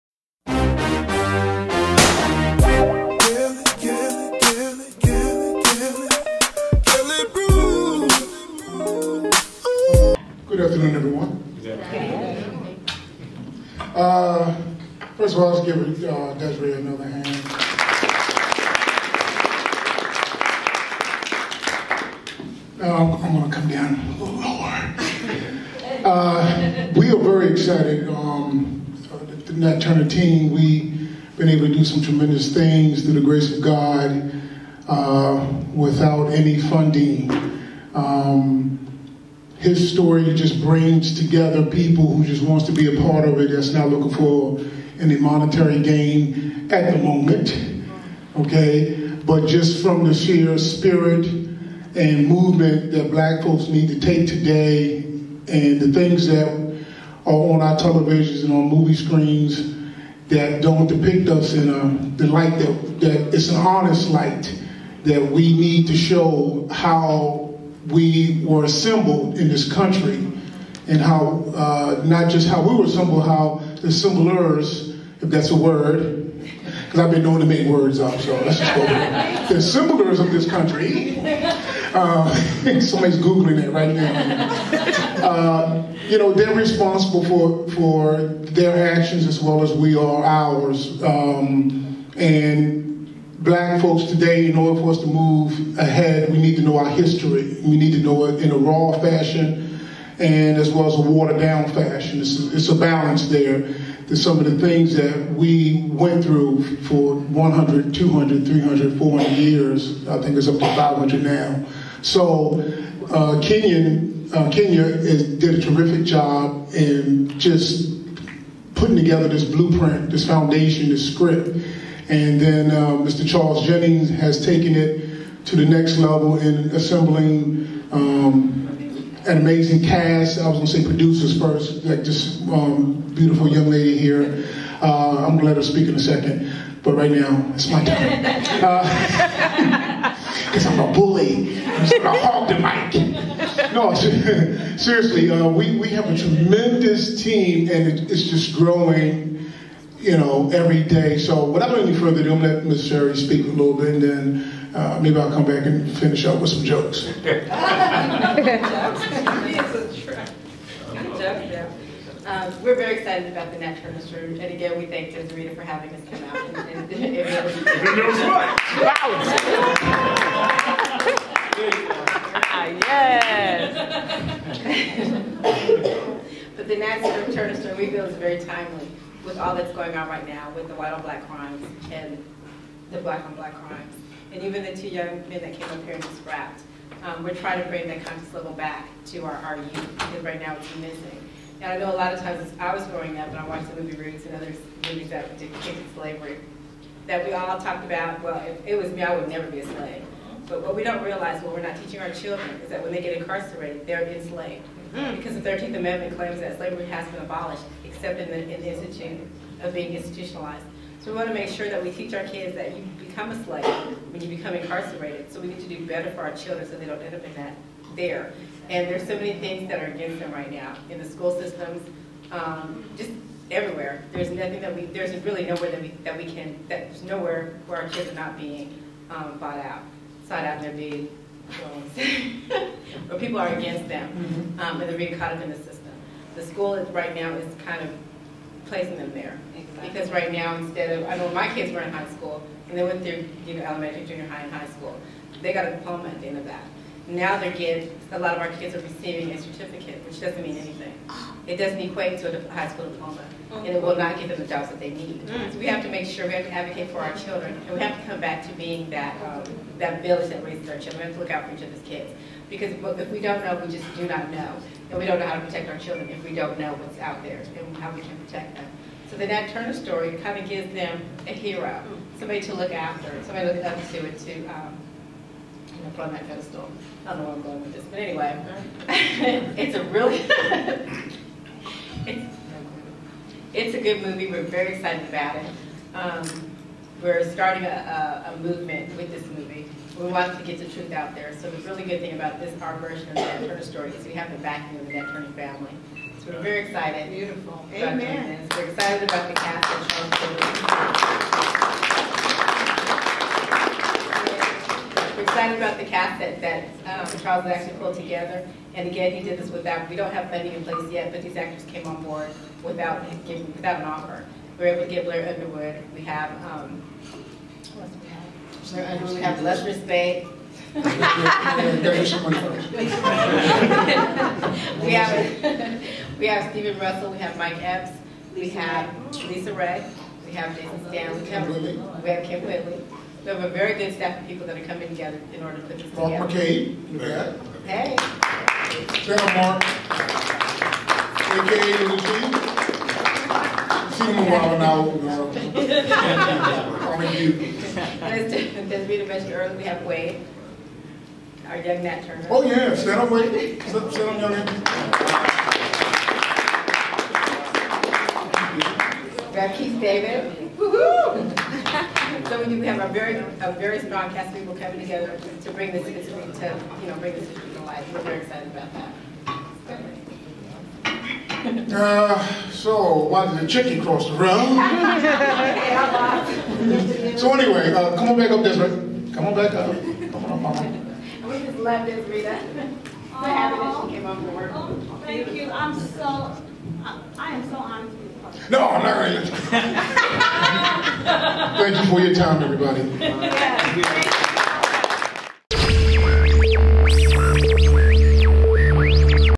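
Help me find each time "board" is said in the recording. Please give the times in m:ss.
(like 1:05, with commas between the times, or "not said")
5:12, 6:24.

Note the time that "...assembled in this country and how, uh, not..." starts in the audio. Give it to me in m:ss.
1:08.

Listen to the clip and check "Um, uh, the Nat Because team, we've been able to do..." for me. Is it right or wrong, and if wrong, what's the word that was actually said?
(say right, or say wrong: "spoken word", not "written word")
wrong: "Turner", not "Because".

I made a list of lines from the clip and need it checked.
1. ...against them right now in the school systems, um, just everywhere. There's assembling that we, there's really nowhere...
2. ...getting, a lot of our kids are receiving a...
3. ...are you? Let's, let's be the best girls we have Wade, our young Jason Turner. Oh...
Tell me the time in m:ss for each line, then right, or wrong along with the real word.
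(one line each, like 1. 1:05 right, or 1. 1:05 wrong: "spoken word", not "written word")
1. 3:39 wrong: "nothing", not "assembling"
2. 4:07 right
3. 5:46 wrong: "Nat", not "Jason".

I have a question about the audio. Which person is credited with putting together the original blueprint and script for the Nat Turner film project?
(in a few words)
Kenya.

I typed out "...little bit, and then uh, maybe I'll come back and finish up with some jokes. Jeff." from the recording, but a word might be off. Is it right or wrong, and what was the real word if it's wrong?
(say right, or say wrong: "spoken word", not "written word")
right.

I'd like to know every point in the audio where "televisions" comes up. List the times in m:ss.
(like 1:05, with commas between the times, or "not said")
0:57.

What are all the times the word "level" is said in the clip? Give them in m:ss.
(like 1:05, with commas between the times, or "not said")
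2:05, 3:08.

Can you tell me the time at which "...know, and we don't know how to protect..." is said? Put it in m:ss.
4:24.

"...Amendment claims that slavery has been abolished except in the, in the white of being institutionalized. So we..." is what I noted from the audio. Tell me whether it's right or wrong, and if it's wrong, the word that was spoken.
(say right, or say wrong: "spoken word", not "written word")
wrong: "institute", not "white".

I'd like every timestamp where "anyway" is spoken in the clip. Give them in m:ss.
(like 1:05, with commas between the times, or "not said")
4:37, 6:17.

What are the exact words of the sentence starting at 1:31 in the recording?
Um, and black folks today, in order for us to move ahead, we need to know our history.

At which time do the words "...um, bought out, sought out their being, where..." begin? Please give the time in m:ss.
3:49.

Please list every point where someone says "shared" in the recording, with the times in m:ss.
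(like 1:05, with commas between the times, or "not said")
not said.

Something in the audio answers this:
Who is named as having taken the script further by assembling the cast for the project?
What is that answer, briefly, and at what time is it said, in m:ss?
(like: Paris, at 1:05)
Charles Jennings, at 2:03.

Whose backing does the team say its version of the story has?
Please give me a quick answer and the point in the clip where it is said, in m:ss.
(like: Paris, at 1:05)
the Nat Turner family, at 4:54.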